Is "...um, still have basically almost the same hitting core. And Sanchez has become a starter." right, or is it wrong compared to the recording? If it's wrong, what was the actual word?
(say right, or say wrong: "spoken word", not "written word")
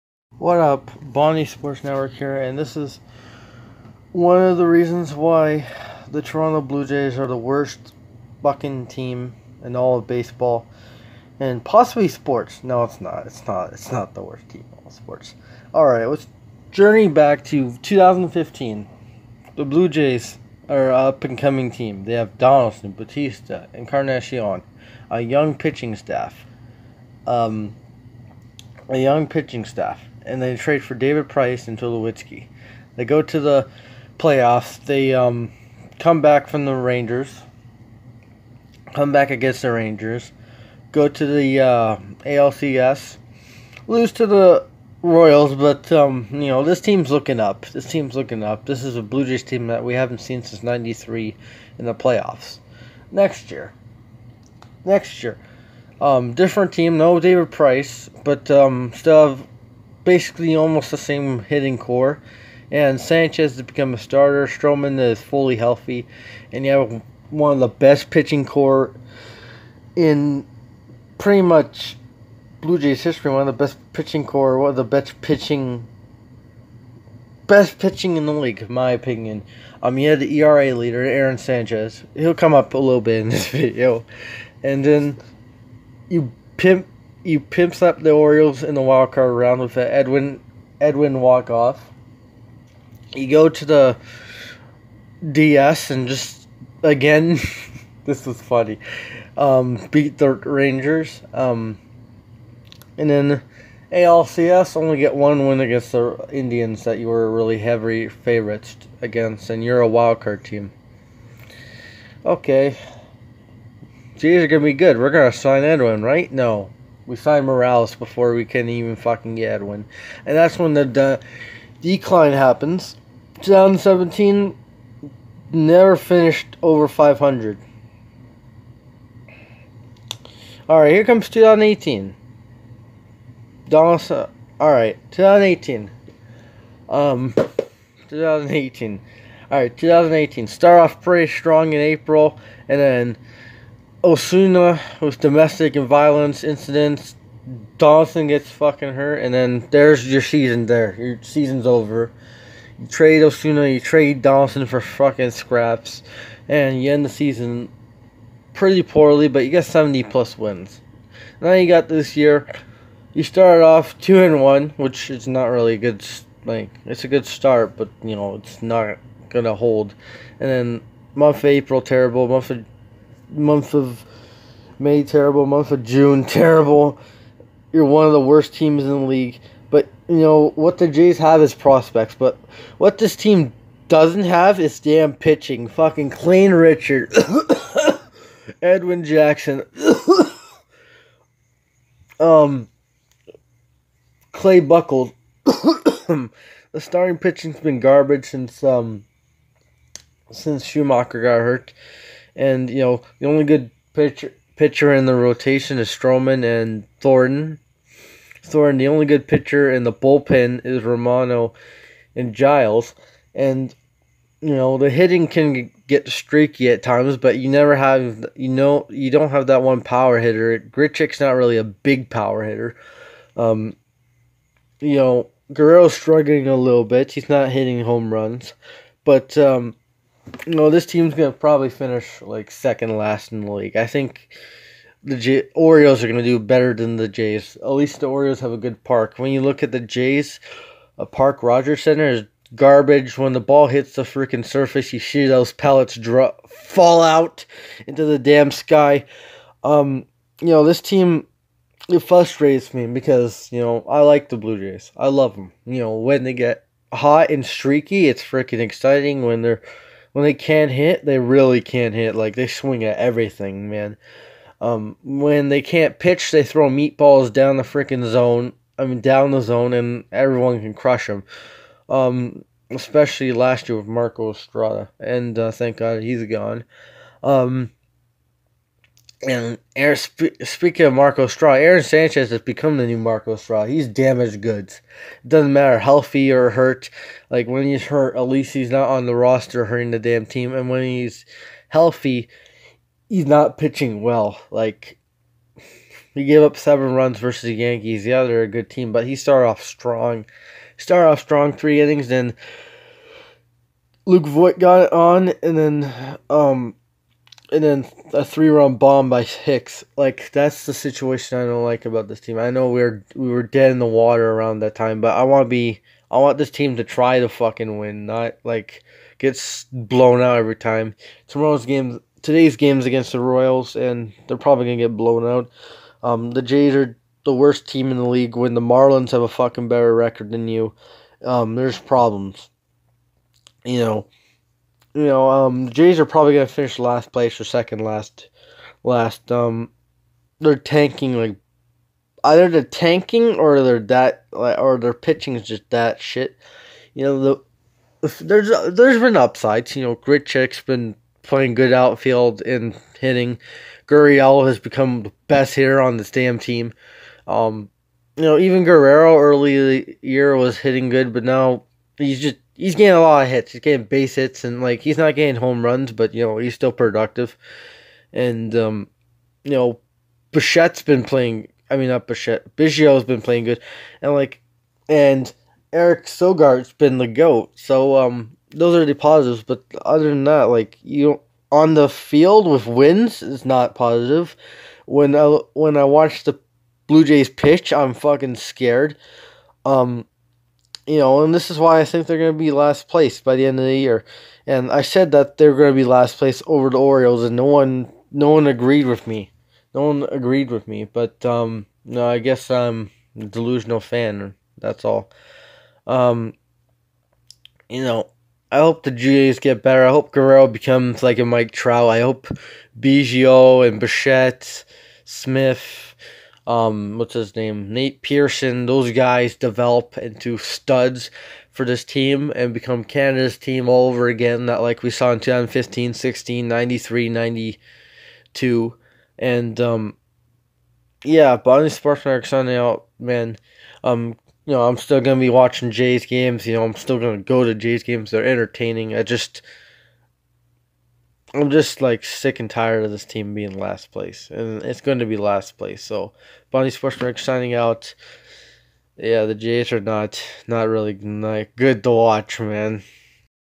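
right.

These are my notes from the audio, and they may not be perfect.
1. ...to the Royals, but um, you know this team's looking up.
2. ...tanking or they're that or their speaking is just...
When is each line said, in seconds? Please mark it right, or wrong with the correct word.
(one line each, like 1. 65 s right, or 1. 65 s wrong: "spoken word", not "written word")
1. 44 s right
2. 342 s wrong: "pitching", not "speaking".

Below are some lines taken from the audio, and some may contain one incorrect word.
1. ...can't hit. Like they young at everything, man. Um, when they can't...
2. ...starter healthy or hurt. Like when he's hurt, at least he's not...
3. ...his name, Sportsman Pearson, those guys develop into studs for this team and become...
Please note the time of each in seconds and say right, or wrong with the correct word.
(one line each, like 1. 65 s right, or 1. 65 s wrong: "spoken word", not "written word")
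1. 261 s wrong: "swing", not "young"
2. 285 s wrong: "matter", not "starter"
3. 417 s wrong: "Nate", not "Sportsman".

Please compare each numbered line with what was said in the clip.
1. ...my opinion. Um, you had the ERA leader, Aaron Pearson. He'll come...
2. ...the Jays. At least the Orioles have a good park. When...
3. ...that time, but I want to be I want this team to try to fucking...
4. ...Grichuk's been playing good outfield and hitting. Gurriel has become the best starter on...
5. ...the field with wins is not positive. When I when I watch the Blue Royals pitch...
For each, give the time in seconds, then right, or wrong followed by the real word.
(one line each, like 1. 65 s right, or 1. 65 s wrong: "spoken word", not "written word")
1. 78 s wrong: "Sanchez", not "Pearson"
2. 236 s right
3. 314 s right
4. 349 s wrong: "hitter", not "starter"
5. 381 s wrong: "Jays", not "Royals".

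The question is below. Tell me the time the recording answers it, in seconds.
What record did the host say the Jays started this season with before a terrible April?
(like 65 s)
163 s.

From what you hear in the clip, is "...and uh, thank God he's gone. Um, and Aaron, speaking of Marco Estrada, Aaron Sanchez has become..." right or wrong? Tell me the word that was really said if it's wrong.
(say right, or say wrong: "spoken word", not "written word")
right.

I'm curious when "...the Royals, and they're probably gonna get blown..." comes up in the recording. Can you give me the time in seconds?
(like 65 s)
323 s.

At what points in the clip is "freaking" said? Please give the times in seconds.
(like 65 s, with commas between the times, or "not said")
244 s, 258 s, 267 s.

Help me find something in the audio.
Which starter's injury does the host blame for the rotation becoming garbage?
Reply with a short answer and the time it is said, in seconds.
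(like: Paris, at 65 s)
Shoemaker, at 200 s.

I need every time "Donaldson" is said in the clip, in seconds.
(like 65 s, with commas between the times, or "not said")
22 s, 133 s, 147 s, 154 s.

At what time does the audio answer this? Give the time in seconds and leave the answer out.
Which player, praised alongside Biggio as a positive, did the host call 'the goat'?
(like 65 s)
375 s.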